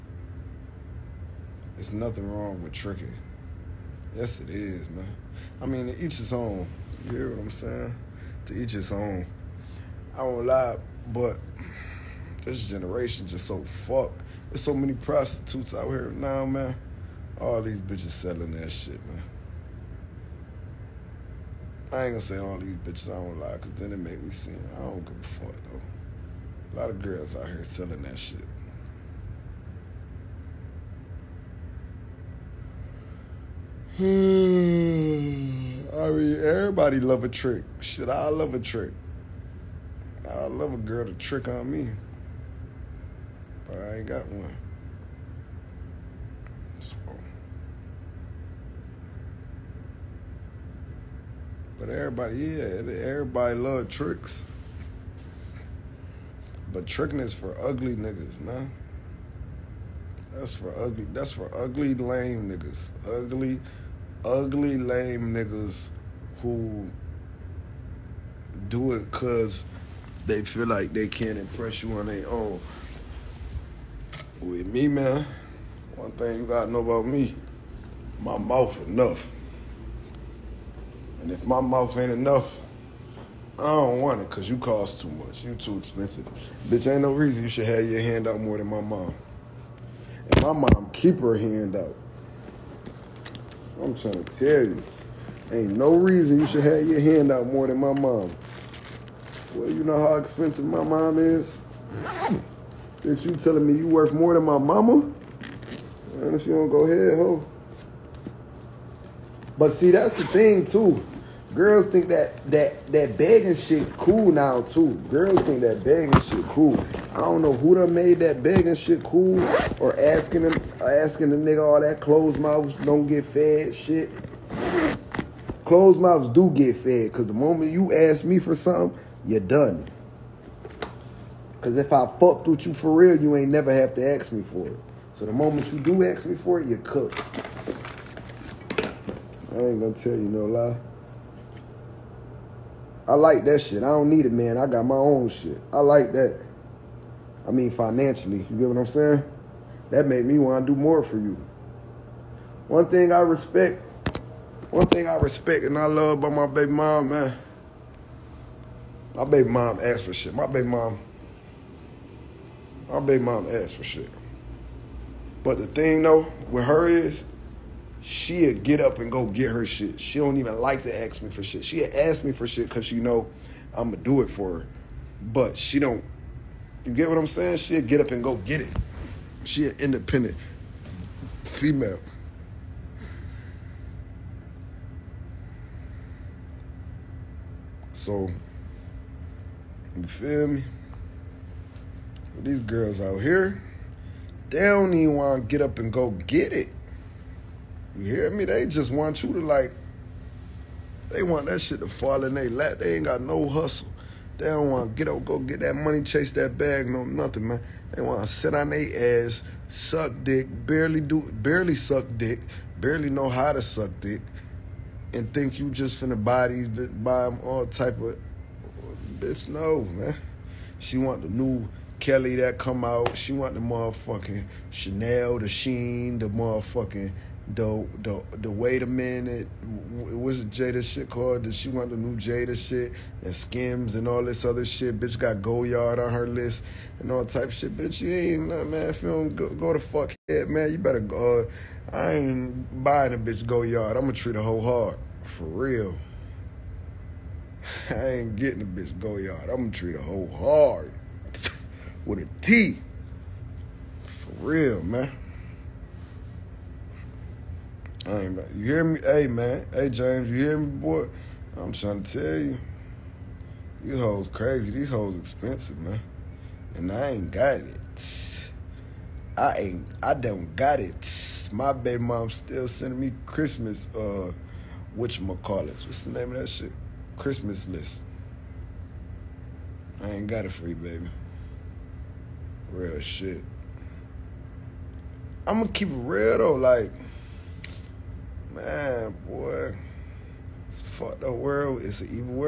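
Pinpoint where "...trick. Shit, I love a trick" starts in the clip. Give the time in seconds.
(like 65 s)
37 s.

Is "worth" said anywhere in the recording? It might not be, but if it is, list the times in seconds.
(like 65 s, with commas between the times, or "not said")
103 s.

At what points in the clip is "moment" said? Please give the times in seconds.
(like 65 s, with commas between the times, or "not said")
127 s, 135 s.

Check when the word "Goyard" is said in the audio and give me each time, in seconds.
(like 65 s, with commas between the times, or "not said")
235 s, 243 s, 248 s.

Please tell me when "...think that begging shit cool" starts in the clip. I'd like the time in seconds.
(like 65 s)
115 s.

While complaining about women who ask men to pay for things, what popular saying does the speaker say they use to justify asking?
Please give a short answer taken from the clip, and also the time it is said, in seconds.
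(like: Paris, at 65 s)
Closed mouths don't get fed, at 122 s.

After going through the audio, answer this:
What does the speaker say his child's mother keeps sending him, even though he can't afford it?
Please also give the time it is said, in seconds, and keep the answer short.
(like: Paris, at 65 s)
Christmas list, at 277 s.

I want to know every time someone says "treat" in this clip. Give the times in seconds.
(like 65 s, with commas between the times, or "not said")
244 s, 249 s.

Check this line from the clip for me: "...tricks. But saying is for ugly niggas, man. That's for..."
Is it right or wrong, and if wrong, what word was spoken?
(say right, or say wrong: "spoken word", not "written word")
wrong: "tricking", not "saying".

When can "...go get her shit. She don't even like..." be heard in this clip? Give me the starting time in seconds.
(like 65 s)
169 s.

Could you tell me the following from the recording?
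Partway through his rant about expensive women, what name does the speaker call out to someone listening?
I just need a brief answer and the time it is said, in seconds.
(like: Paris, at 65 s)
James, at 259 s.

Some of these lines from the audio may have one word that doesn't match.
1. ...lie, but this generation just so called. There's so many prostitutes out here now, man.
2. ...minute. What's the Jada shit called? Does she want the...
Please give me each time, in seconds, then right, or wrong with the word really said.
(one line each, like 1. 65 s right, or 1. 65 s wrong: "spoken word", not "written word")
1. 10 s wrong: "fucked", not "called"
2. 228 s right.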